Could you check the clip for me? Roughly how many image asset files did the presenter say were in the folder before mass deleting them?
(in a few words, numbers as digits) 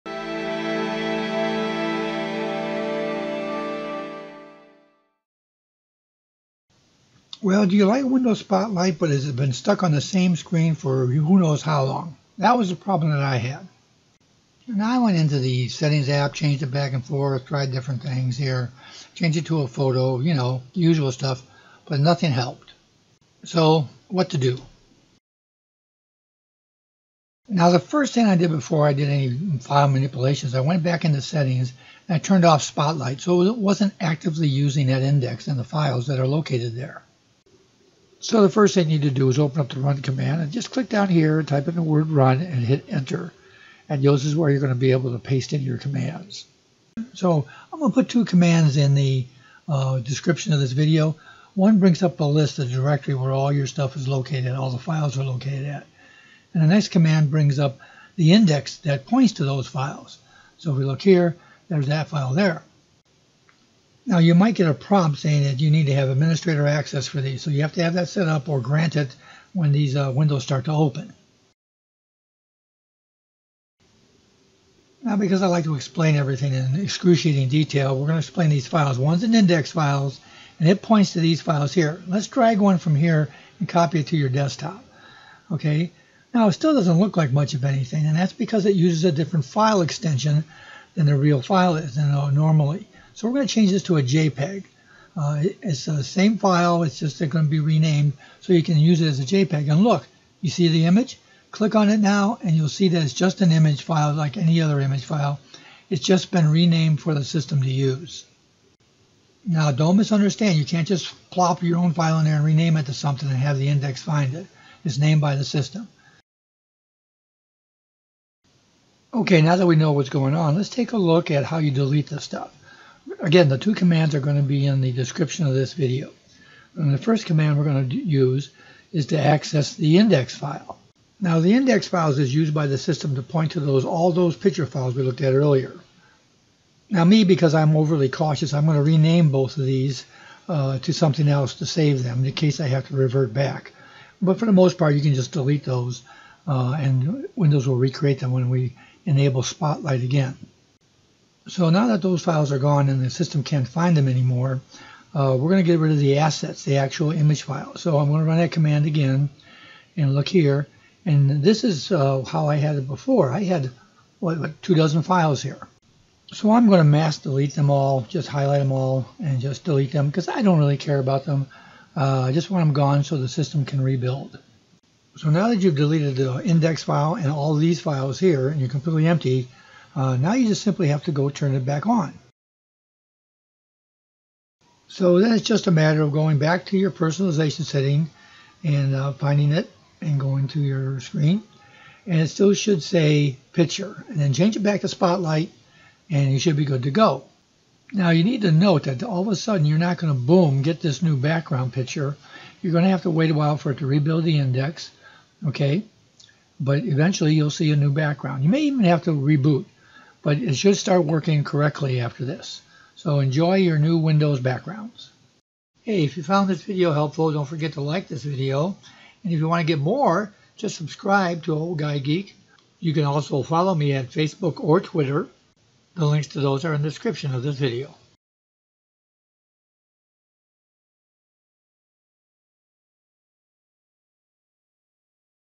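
2 dozen.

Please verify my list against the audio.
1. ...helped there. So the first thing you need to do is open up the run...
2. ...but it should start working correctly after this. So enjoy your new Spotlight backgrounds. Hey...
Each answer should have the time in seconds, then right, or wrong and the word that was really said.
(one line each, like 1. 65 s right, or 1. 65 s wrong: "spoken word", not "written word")
1. 36 s wrong: "located", not "helped"
2. 210 s wrong: "Windows", not "Spotlight".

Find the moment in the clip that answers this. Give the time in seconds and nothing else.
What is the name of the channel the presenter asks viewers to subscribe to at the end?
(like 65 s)
221 s.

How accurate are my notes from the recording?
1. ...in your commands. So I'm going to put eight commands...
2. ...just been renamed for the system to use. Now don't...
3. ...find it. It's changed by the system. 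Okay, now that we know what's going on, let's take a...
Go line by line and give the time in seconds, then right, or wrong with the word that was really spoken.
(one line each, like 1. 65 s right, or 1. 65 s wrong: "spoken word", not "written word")
1. 45 s wrong: "two", not "eight"
2. 106 s right
3. 114 s wrong: "named", not "changed".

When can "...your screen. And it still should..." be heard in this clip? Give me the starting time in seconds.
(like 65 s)
190 s.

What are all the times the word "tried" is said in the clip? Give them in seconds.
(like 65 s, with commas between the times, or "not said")
17 s.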